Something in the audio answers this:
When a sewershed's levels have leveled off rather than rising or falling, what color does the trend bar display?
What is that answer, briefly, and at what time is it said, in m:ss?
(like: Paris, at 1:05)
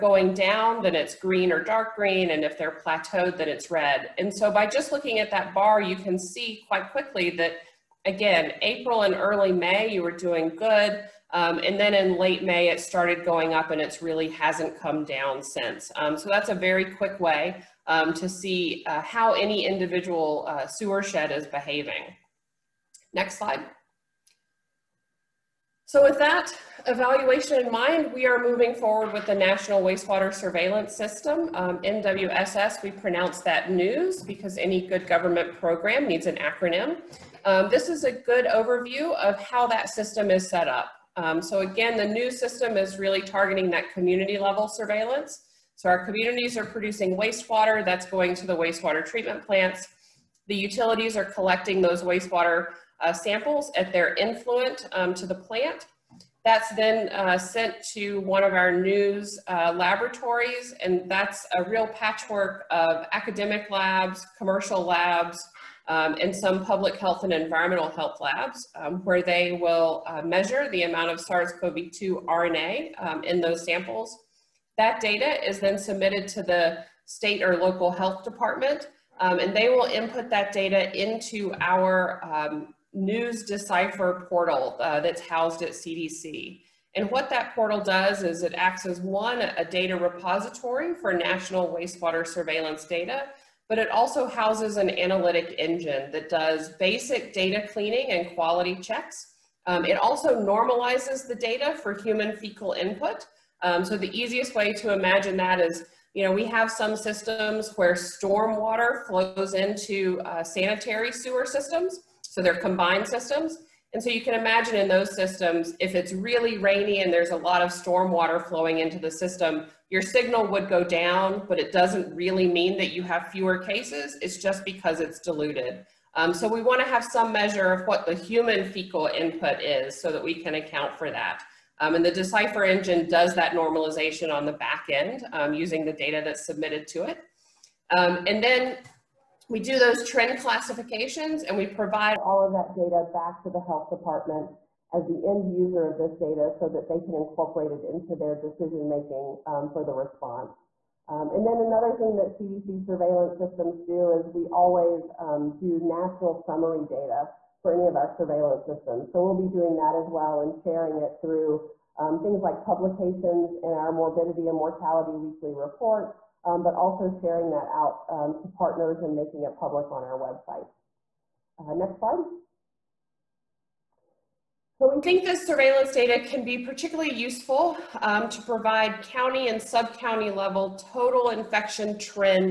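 Red, at 0:03.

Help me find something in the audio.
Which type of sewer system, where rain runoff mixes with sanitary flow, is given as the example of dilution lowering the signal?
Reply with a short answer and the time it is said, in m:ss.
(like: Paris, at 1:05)
Combined systems, at 1:52.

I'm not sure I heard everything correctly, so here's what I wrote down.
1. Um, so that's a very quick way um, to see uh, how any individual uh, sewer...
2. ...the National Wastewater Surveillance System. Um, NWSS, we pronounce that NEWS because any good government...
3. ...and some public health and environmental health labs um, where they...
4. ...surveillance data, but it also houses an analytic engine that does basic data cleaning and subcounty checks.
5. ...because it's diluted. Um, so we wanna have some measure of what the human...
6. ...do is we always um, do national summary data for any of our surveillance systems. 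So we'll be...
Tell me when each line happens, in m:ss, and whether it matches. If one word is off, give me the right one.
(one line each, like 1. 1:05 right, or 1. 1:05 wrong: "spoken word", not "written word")
1. 0:15 right
2. 0:29 right
3. 1:06 right
4. 1:32 wrong: "quality", not "subcounty"
5. 2:04 right
6. 2:33 right.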